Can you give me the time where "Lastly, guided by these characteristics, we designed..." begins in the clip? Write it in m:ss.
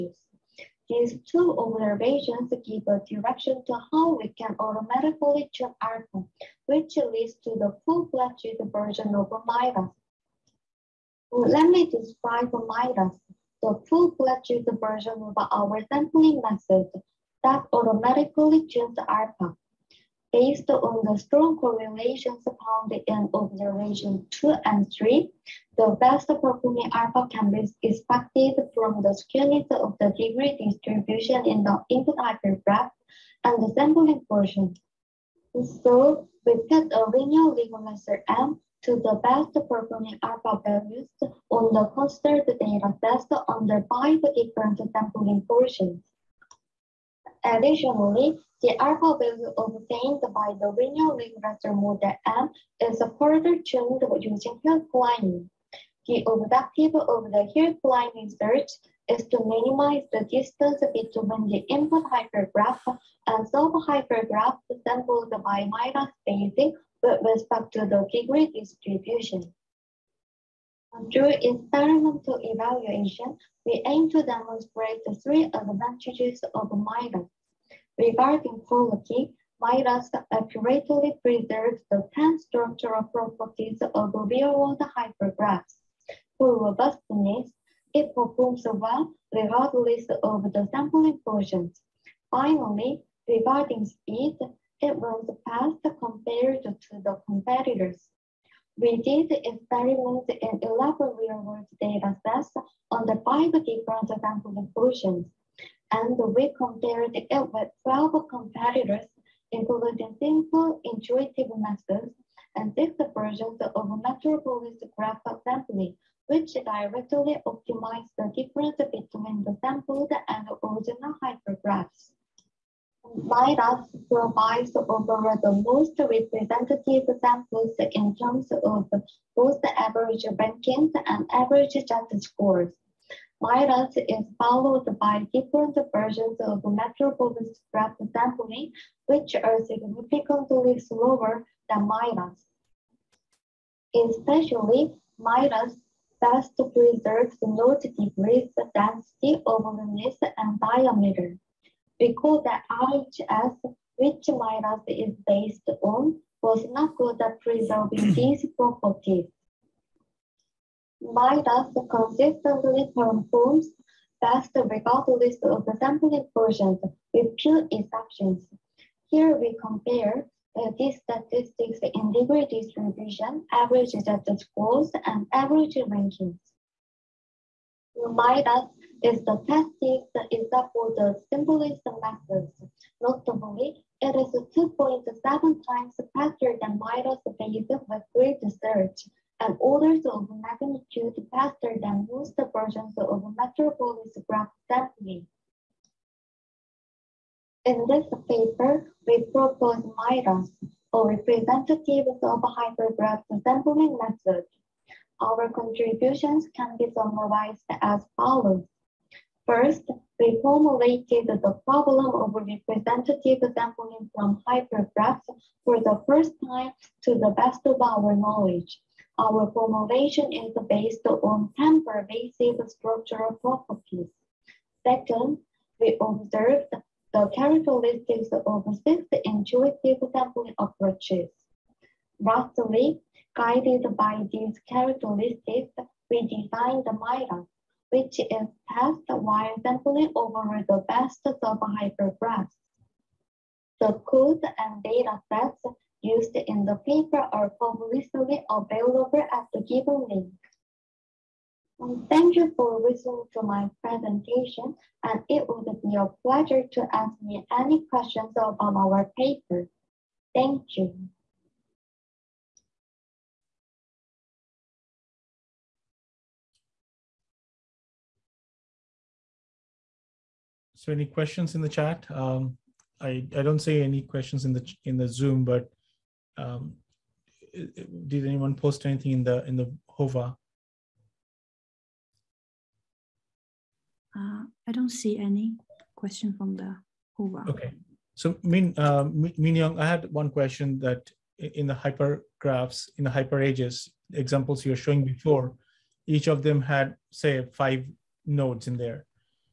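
3:52.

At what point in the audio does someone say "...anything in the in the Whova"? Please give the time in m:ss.
4:38.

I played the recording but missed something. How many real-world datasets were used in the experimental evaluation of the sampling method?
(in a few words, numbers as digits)
11.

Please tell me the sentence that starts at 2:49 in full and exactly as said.
Here we compare uh, these statistics in degree distribution, average data scores, and average rankings.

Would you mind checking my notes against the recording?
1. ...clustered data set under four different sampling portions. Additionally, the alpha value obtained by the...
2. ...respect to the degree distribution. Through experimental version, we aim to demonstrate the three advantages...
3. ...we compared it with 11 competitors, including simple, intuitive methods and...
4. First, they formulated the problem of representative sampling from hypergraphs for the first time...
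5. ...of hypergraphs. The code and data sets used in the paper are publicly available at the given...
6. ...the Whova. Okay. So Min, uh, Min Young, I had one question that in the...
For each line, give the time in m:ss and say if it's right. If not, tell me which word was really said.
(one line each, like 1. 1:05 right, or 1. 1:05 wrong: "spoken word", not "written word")
1. 0:41 wrong: "five", not "four"
2. 1:07 wrong: "evaluation", not "version"
3. 1:46 wrong: "12", not "11"
4. 3:29 right
5. 4:01 right
6. 4:46 right.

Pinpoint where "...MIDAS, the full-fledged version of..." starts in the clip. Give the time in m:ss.
0:12.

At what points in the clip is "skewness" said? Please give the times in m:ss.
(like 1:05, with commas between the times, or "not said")
0:29.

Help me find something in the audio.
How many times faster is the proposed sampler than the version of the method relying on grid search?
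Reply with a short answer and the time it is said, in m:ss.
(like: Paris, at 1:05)
2.7, at 3:04.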